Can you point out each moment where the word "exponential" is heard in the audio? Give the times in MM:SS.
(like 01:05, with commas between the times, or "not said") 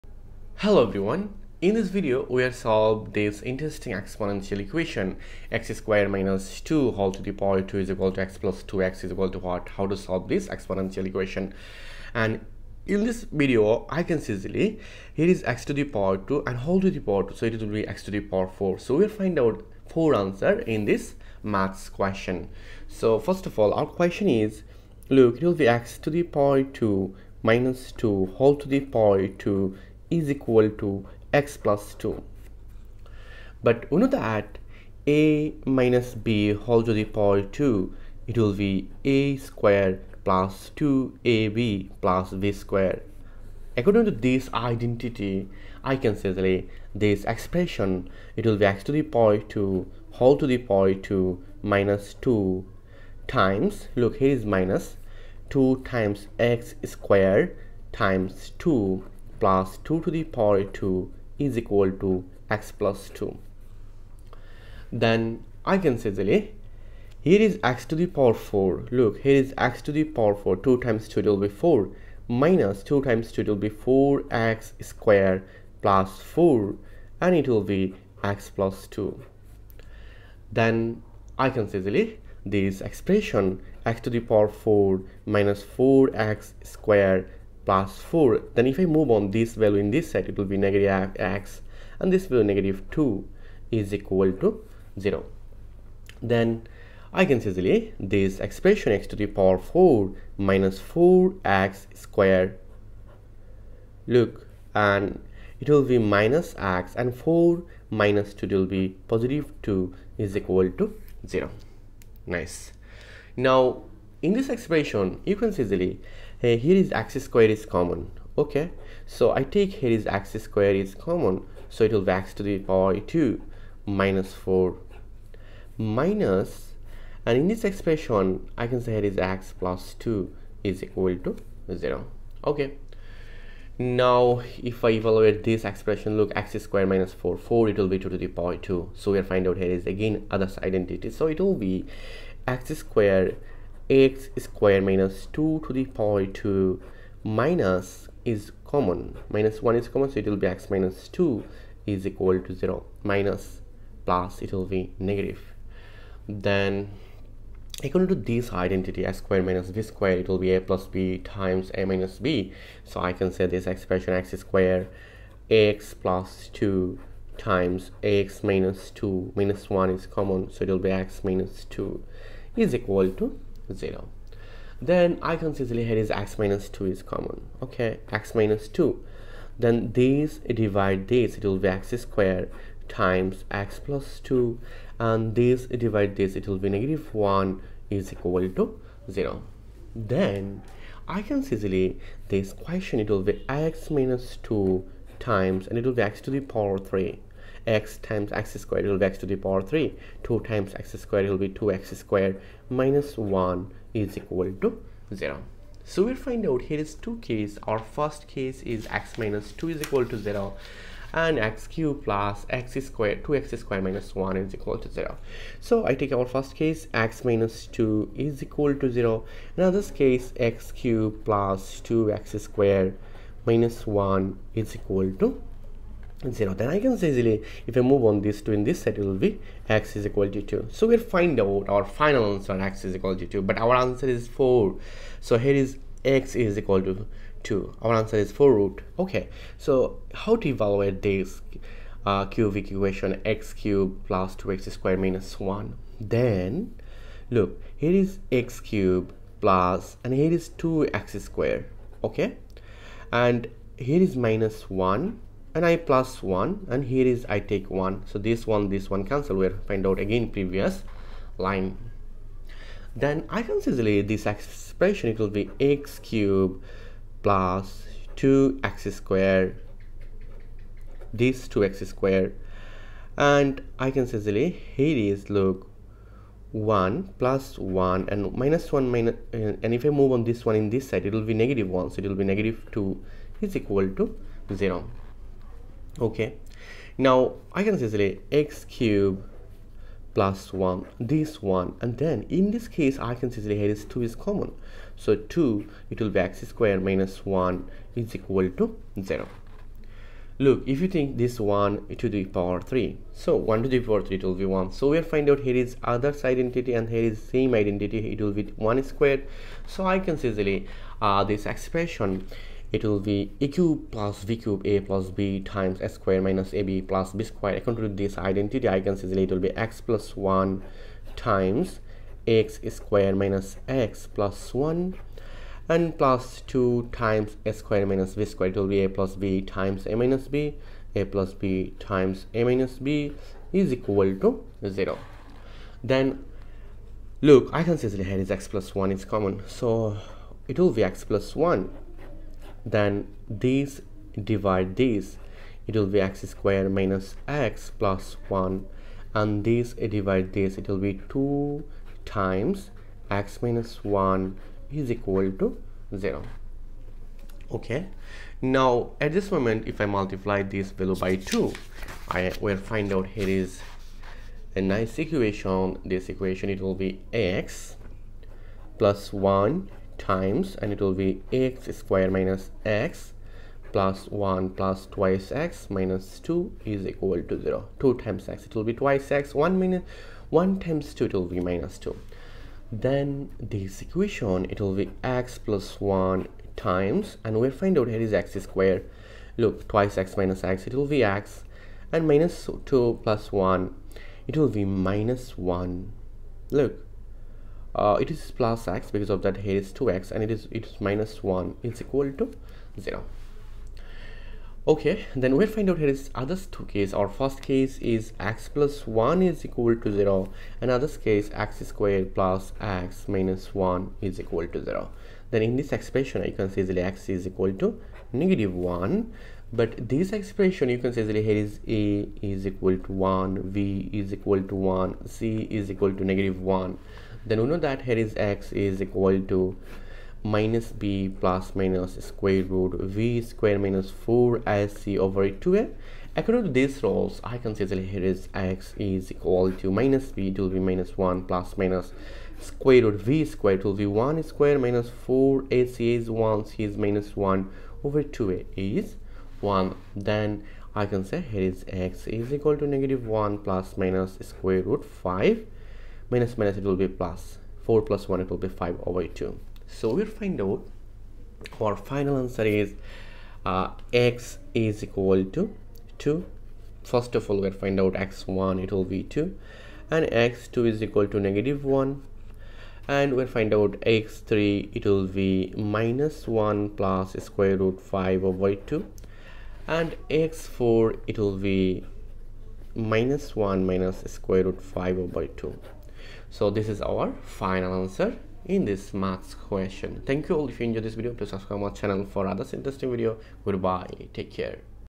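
00:03, 00:10.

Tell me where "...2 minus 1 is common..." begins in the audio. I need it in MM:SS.
02:48.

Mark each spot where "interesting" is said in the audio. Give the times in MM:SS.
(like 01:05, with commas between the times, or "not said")
00:03, 08:12.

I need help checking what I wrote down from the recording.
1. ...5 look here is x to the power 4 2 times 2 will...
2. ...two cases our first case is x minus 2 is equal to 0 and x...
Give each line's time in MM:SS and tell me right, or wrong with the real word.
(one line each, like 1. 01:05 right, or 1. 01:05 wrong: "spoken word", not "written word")
1. 01:08 wrong: "4", not "5"
2. 03:26 right.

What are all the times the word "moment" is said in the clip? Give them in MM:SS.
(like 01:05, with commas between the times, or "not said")
05:59.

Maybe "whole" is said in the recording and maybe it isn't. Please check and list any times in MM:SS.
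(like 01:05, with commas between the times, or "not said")
00:06, 00:16, 00:28, 00:36, 00:50.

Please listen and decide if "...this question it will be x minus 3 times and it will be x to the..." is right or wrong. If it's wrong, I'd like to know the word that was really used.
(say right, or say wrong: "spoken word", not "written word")
wrong: "2", not "3".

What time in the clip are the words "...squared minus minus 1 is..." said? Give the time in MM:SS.
04:56.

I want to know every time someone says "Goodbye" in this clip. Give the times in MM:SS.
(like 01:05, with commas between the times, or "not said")
08:13.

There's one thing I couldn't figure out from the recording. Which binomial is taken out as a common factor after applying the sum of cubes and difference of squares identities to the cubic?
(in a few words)
x plus 1.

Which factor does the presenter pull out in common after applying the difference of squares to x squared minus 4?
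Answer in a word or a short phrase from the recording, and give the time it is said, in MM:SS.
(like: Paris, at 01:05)
x minus 2, at 02:56.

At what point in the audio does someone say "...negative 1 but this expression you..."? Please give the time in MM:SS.
06:58.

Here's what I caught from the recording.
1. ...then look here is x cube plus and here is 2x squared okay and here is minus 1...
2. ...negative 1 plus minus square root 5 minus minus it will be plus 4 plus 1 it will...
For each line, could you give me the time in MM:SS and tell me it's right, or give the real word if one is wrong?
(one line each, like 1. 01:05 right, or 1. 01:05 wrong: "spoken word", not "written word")
1. 04:05 right
2. 07:32 right.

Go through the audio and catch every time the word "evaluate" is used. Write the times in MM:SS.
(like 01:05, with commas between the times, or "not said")
02:14, 04:00.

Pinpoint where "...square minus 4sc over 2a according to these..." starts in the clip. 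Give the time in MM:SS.
07:13.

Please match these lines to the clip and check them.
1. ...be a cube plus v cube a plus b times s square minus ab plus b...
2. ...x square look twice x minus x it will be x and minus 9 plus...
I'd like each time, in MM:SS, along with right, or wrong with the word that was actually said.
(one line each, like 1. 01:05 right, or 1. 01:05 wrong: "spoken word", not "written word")
1. 05:12 right
2. 06:28 wrong: "2", not "9".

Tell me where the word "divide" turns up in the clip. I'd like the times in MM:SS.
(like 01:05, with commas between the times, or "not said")
03:00, 03:05, 05:44, 05:49.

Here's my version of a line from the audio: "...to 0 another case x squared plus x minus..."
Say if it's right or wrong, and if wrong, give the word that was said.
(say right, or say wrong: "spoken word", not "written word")
right.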